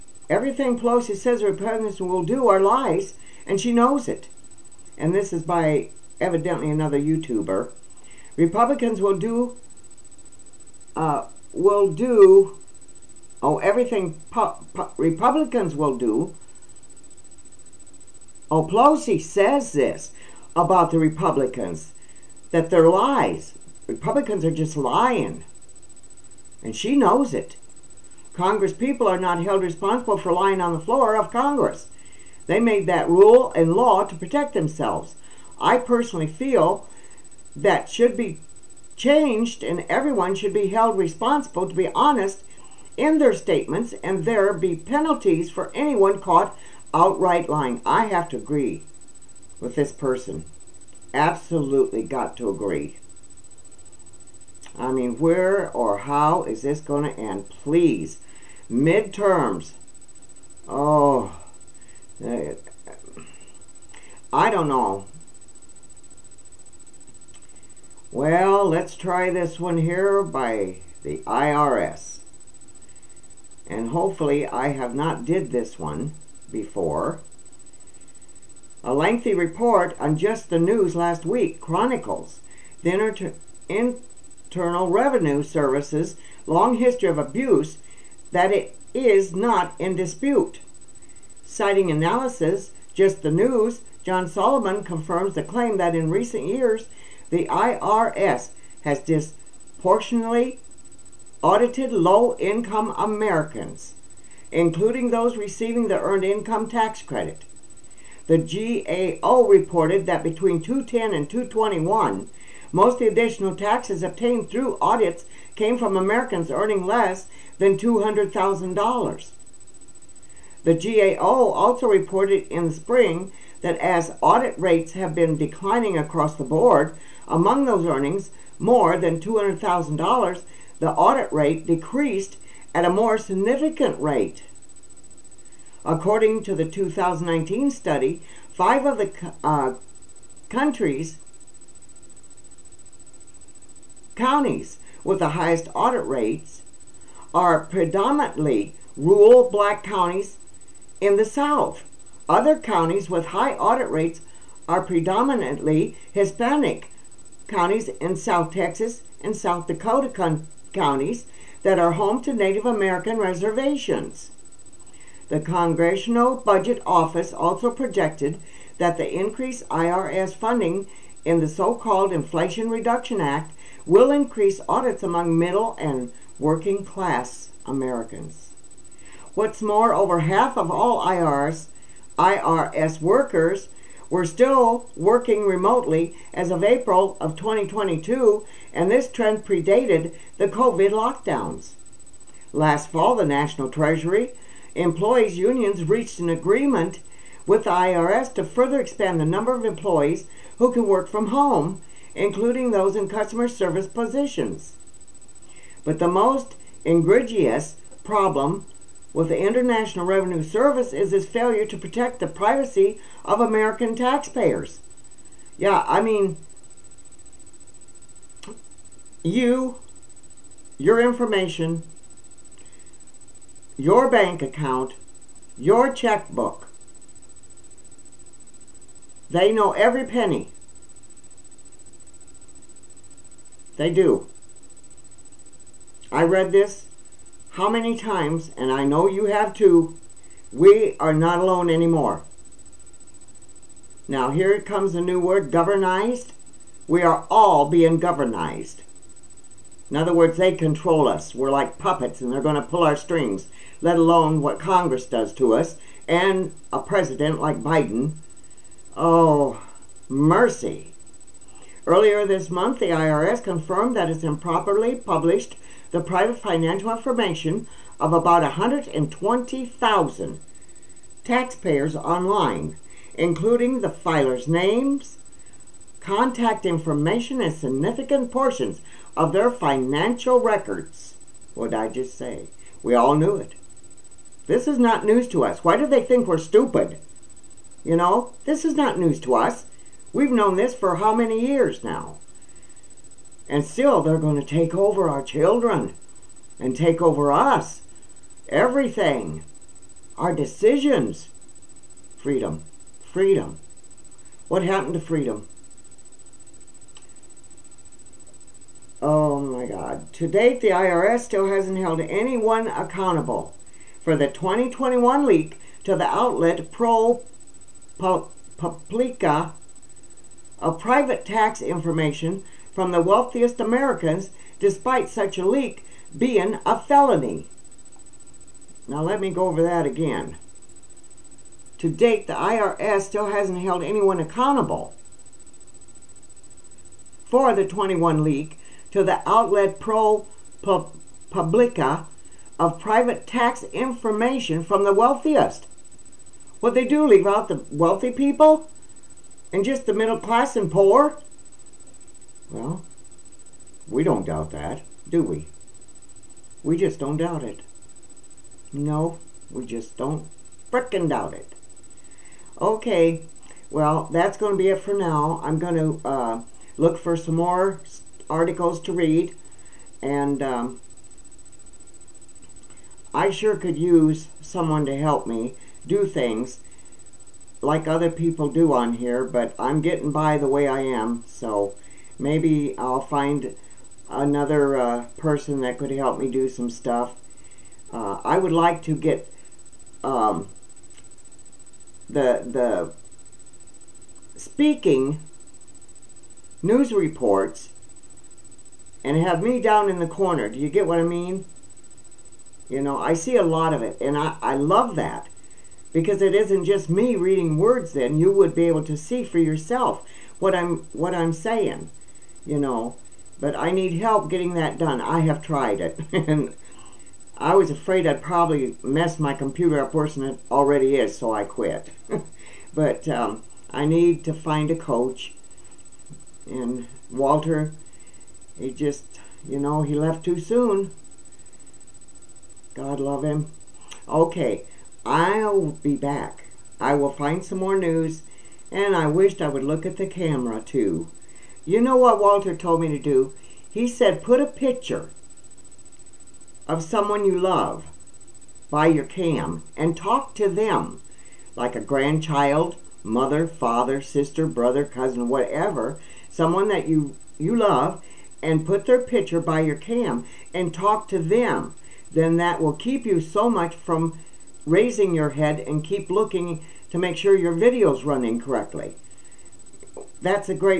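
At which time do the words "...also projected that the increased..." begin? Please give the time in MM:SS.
02:47.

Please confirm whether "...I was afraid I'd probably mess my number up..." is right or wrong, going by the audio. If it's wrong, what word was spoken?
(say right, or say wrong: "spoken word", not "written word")
wrong: "computer", not "number".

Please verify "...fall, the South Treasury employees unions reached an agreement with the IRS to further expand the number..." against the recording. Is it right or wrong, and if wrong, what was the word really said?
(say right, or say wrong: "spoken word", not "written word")
wrong: "National", not "South".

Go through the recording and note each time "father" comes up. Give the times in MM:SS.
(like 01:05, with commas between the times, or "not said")
07:33.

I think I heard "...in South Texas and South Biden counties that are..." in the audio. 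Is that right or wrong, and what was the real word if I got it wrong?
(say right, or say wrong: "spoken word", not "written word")
wrong: "Dakota", not "Biden".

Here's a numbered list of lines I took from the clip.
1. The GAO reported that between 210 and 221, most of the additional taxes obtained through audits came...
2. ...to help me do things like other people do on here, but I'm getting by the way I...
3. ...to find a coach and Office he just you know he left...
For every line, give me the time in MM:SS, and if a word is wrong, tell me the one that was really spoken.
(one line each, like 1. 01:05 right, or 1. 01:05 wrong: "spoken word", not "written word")
1. 01:48 right
2. 06:14 right
3. 07:04 wrong: "Walter", not "Office".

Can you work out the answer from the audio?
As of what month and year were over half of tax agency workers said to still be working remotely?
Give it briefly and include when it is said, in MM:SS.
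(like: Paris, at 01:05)
April 2022, at 03:06.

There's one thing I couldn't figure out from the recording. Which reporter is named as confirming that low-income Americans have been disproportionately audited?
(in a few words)
John Solomon.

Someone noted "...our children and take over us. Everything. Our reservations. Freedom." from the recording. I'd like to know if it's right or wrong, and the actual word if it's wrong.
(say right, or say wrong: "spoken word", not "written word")
wrong: "decisions", not "reservations".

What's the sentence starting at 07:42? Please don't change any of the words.
Then that will keep you so much from raising your head and keep looking to make sure your video's running correctly.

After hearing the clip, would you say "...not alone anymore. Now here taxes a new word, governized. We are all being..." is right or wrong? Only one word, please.
wrong.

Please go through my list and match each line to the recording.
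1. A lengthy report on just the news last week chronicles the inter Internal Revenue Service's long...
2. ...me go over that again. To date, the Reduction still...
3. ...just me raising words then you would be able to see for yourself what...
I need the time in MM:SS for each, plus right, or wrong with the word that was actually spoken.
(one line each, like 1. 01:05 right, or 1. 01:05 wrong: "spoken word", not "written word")
1. 01:18 right
2. 05:29 wrong: "IRS", not "Reduction"
3. 06:46 wrong: "reading", not "raising".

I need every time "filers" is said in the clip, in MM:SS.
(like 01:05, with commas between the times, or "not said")
04:33.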